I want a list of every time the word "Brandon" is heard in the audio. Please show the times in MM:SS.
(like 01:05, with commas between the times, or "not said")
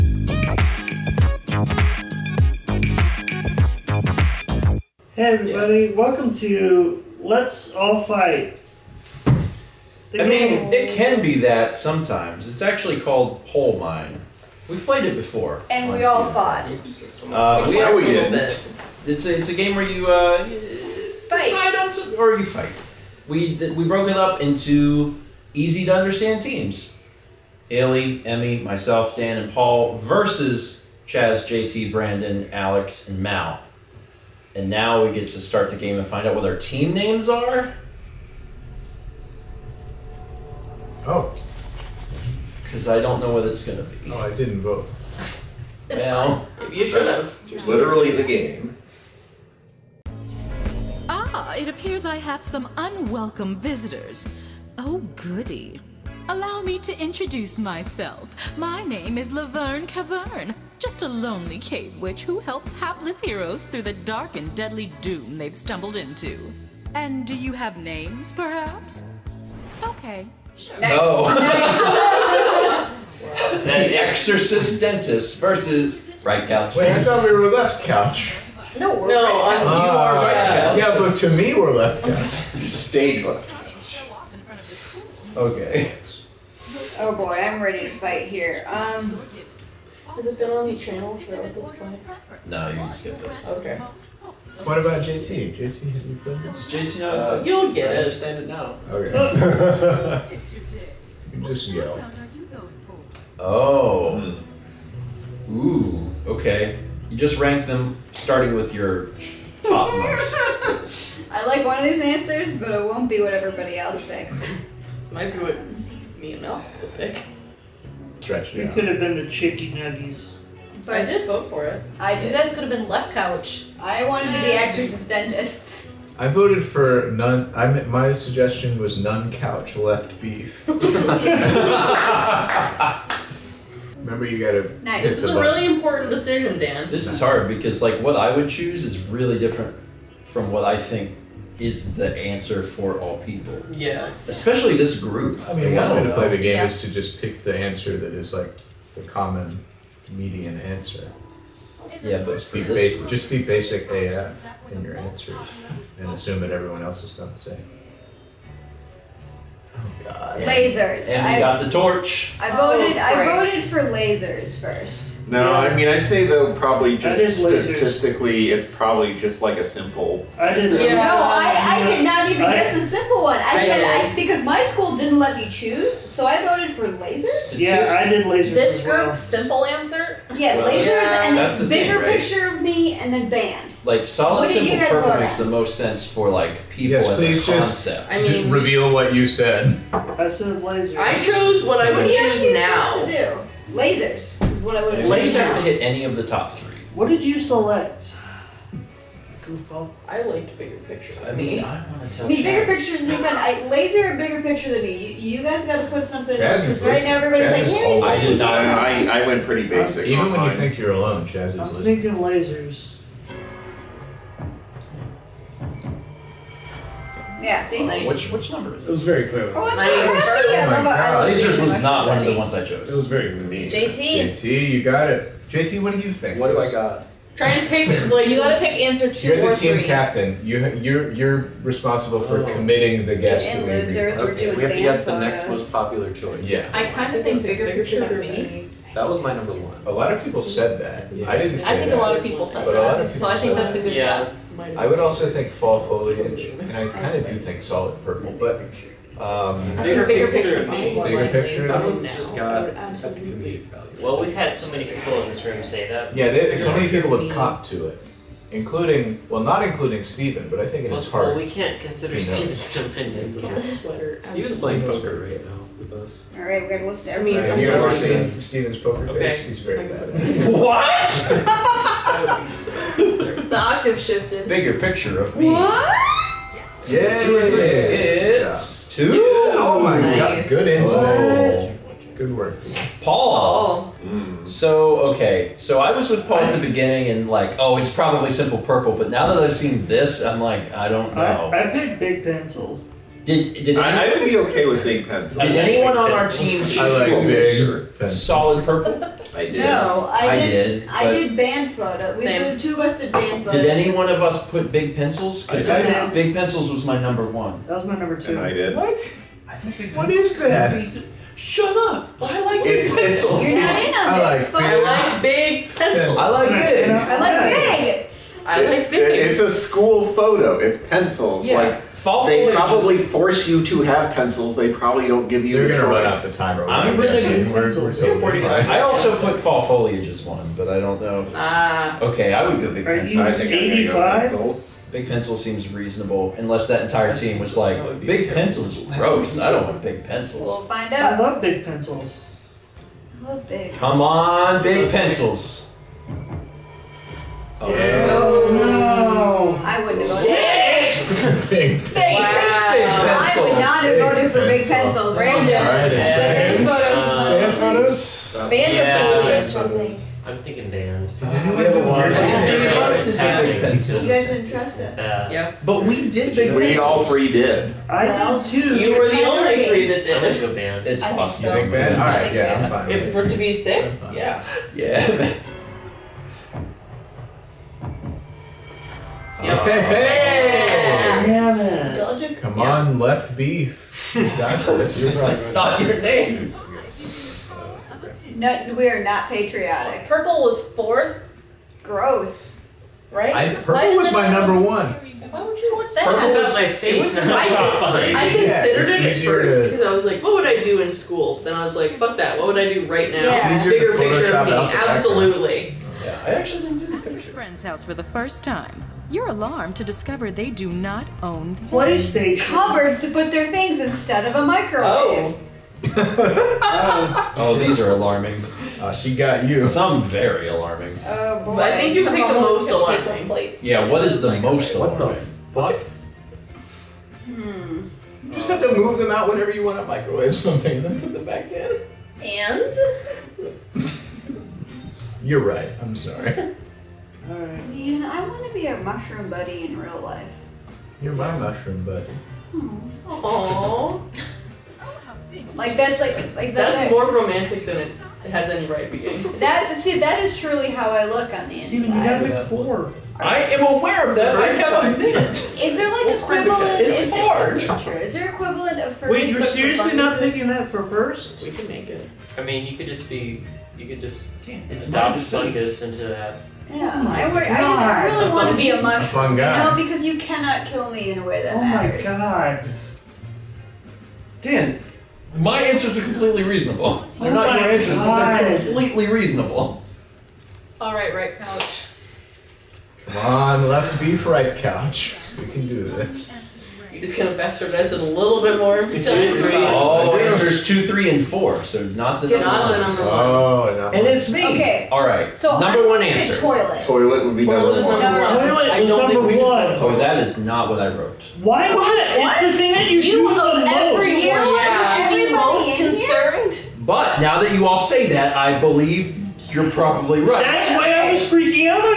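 00:31, 05:55.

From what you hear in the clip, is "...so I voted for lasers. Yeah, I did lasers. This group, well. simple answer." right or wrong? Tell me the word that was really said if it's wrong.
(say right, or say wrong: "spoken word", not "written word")
right.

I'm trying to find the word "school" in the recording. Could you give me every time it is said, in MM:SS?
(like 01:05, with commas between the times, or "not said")
02:54, 05:19, 06:40.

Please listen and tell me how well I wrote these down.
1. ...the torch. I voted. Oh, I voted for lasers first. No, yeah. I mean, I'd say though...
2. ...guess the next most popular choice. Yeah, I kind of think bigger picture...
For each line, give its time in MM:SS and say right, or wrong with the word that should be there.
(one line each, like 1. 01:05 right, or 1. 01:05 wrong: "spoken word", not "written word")
1. 02:41 right
2. 03:54 right.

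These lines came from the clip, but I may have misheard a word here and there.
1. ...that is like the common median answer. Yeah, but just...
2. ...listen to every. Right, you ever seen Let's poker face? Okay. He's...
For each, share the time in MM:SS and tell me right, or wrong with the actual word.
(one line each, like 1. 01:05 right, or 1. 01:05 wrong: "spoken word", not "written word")
1. 02:27 right
2. 04:26 wrong: "Stephen", not "Let".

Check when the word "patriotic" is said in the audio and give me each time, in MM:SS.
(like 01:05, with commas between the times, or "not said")
06:29.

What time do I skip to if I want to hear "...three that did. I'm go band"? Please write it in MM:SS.
06:09.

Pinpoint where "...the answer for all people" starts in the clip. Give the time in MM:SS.
02:21.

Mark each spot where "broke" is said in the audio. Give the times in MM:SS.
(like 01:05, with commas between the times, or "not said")
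00:23.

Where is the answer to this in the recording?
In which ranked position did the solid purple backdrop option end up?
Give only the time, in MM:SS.
06:30.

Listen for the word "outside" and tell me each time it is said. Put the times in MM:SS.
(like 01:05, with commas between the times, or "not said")
not said.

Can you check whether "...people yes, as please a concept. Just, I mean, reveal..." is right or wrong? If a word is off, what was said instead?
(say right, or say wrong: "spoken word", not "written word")
right.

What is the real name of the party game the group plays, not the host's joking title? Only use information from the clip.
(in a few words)
Poll Mine.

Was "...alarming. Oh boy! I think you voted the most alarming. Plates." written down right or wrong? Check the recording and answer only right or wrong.
wrong.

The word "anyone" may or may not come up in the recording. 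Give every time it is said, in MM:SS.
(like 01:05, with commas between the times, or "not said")
04:55, 06:01.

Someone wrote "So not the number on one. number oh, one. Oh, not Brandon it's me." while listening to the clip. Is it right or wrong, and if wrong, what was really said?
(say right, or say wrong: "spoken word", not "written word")
wrong: "And", not "Brandon".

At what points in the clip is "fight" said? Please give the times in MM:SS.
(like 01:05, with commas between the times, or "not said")
00:08, 00:22, 01:27.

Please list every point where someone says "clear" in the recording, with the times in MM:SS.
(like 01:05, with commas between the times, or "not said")
03:39, 03:43.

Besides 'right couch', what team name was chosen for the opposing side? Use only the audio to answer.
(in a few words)
the exorcist dentist.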